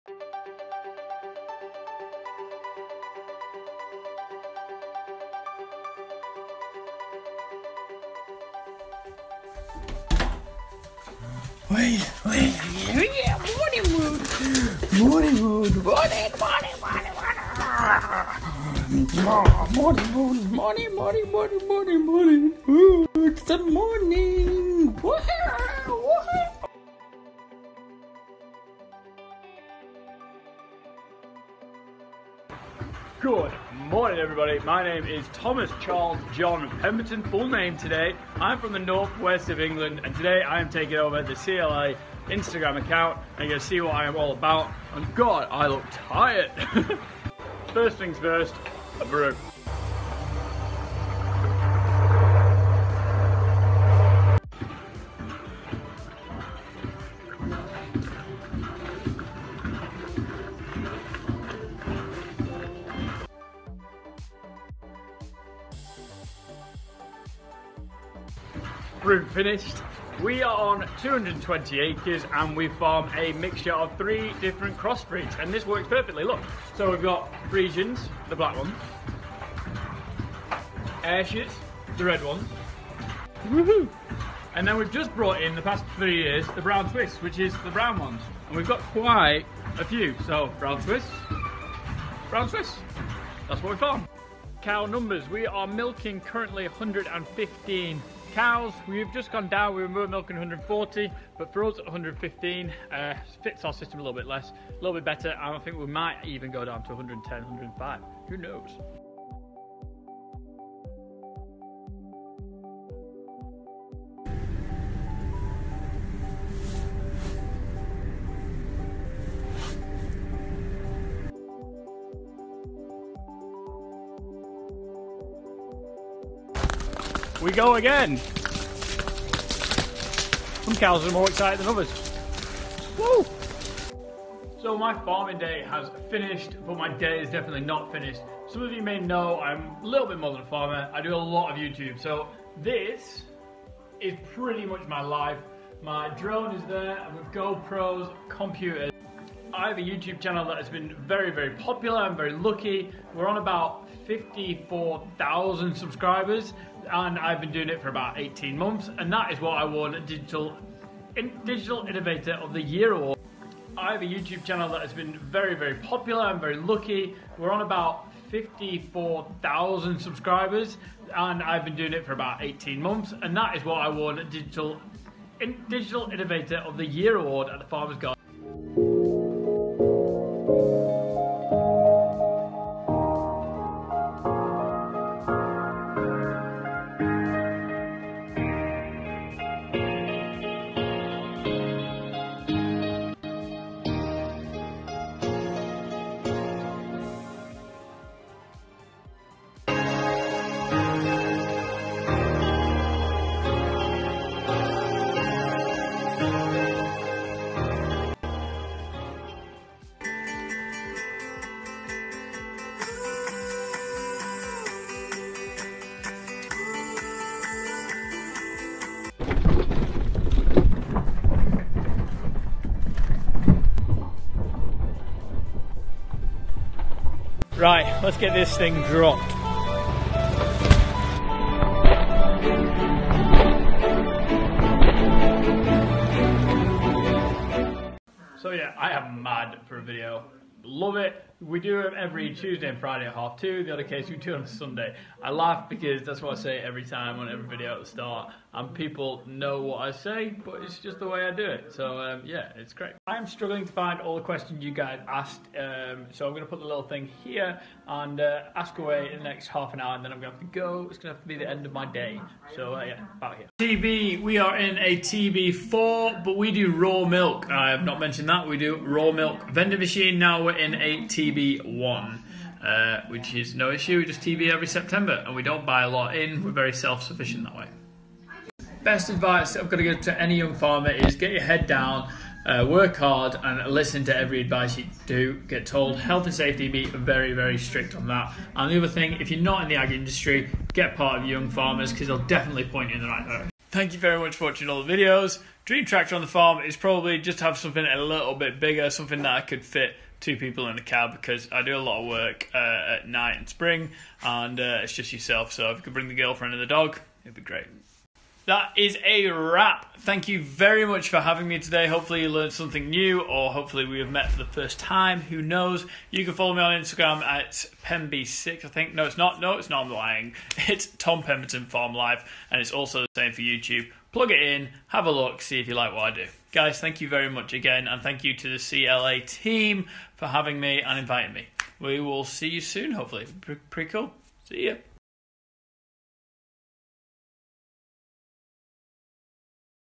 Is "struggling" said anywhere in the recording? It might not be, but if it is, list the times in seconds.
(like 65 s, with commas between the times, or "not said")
253 s.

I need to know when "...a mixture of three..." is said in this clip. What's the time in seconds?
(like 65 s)
73 s.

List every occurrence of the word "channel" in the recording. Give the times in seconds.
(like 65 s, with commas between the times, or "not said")
150 s, 164 s.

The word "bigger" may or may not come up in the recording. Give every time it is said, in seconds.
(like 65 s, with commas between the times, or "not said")
298 s.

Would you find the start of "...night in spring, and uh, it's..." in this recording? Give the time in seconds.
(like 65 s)
303 s.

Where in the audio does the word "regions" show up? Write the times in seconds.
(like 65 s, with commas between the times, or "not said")
not said.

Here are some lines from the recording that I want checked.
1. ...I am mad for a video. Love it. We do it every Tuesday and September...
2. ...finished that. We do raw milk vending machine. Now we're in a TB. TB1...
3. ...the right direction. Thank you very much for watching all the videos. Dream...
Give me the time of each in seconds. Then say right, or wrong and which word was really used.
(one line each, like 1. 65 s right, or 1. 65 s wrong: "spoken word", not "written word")
1. 238 s wrong: "Friday", not "September"
2. 267 s wrong: "mentioned", not "finished"
3. 293 s right.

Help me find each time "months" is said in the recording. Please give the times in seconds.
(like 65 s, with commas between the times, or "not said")
158 s, 172 s.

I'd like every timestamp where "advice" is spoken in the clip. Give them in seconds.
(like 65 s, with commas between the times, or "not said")
279 s, 284 s.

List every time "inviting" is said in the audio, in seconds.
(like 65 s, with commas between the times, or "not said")
330 s.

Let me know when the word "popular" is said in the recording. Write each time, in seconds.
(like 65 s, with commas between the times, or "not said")
151 s, 165 s.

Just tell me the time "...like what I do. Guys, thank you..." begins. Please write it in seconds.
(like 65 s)
325 s.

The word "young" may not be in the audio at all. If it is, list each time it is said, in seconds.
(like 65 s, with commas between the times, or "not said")
280 s, 291 s.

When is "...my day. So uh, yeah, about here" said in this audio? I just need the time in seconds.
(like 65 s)
261 s.